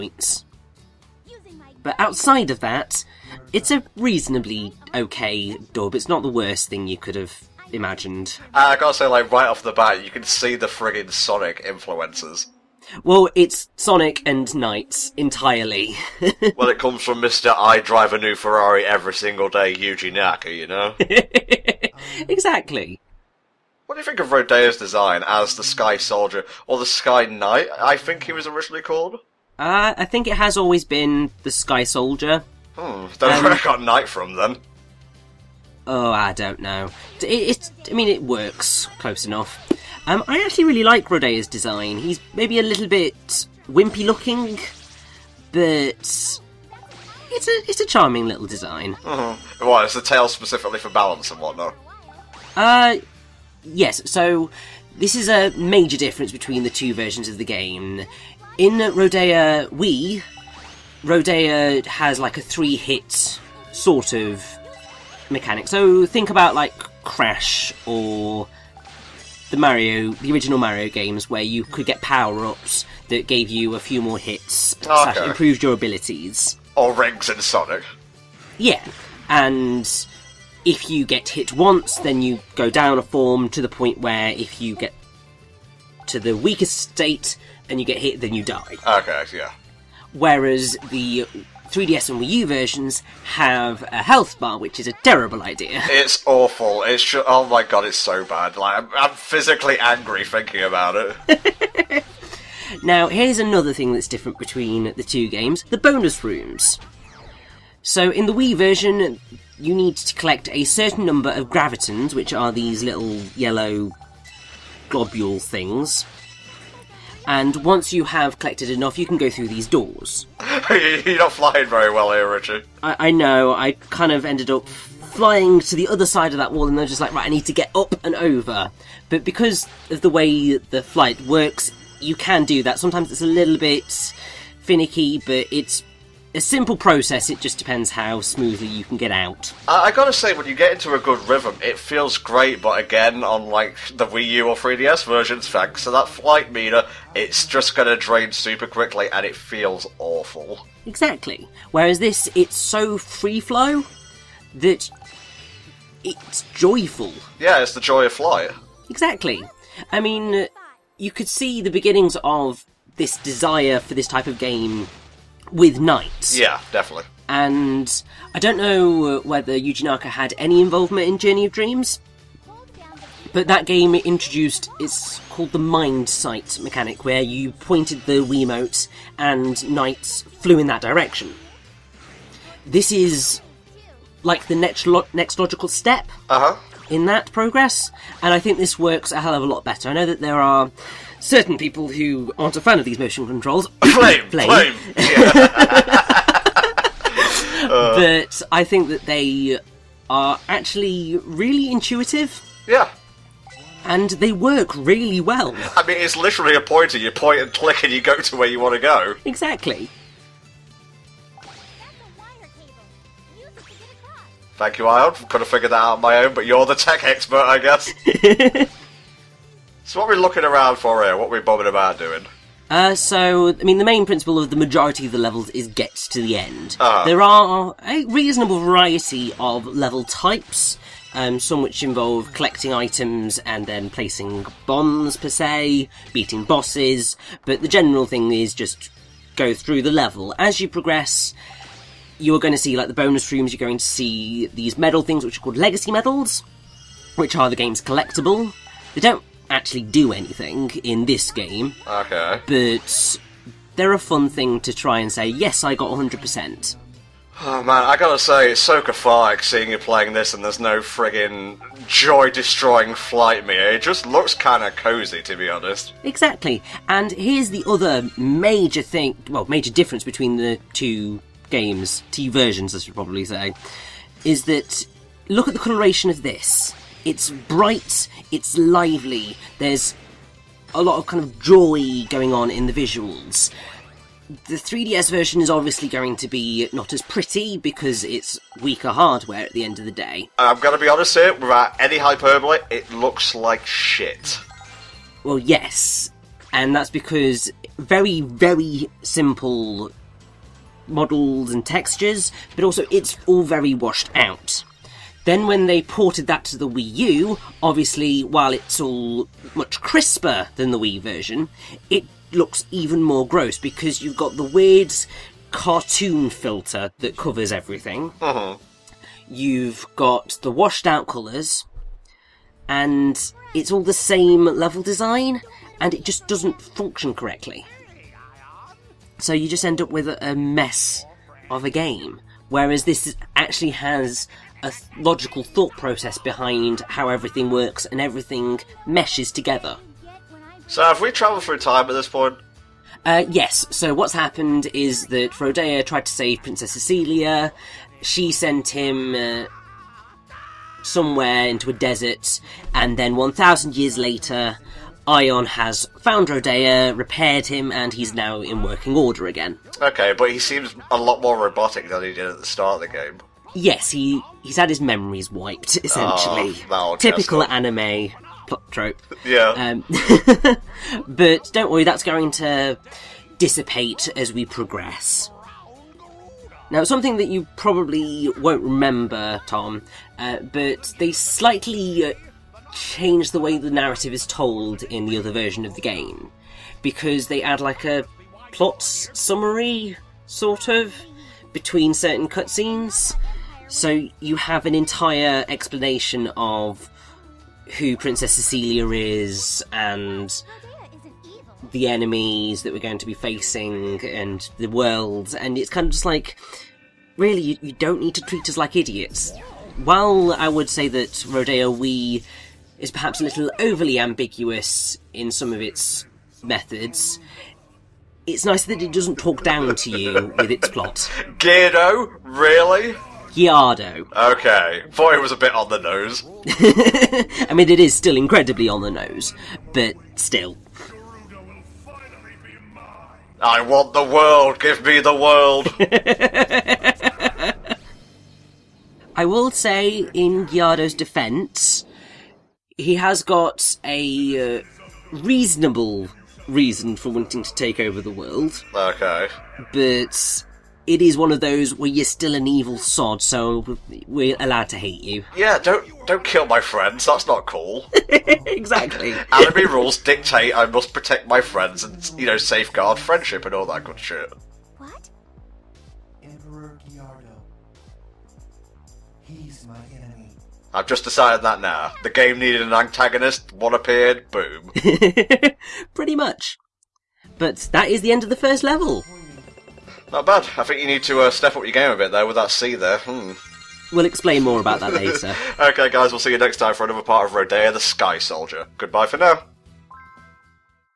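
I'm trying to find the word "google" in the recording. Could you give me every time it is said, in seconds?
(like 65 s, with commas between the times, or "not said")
not said.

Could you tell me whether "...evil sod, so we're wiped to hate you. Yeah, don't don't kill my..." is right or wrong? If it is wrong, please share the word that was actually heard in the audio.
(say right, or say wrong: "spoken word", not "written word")
wrong: "allowed", not "wiped".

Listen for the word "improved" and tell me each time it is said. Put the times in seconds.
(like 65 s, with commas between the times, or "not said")
75 s.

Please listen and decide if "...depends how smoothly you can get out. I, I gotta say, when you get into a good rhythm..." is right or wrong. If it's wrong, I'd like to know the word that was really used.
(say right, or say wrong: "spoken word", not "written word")
right.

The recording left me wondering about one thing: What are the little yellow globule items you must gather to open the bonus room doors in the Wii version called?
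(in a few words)
gravitons.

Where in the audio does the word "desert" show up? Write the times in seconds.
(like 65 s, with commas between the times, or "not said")
351 s.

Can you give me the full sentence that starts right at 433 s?
I want the world, give me the world!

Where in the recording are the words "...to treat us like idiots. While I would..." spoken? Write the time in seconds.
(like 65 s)
408 s.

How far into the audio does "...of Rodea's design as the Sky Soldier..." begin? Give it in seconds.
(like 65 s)
24 s.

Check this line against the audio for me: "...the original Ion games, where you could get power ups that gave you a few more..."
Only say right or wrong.
wrong.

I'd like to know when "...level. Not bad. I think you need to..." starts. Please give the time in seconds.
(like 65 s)
478 s.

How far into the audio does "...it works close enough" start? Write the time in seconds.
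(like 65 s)
38 s.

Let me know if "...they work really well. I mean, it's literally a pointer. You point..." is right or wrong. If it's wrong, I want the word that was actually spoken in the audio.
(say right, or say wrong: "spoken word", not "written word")
right.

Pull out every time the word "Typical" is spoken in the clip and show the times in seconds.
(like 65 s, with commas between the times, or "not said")
366 s.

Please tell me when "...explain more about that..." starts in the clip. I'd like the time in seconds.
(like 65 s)
484 s.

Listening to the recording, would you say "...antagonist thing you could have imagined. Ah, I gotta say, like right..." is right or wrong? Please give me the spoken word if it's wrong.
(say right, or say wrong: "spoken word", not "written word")
wrong: "worst", not "antagonist".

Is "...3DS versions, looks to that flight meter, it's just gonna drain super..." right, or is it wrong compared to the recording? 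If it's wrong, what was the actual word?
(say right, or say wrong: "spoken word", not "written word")
wrong: "thanks", not "looks".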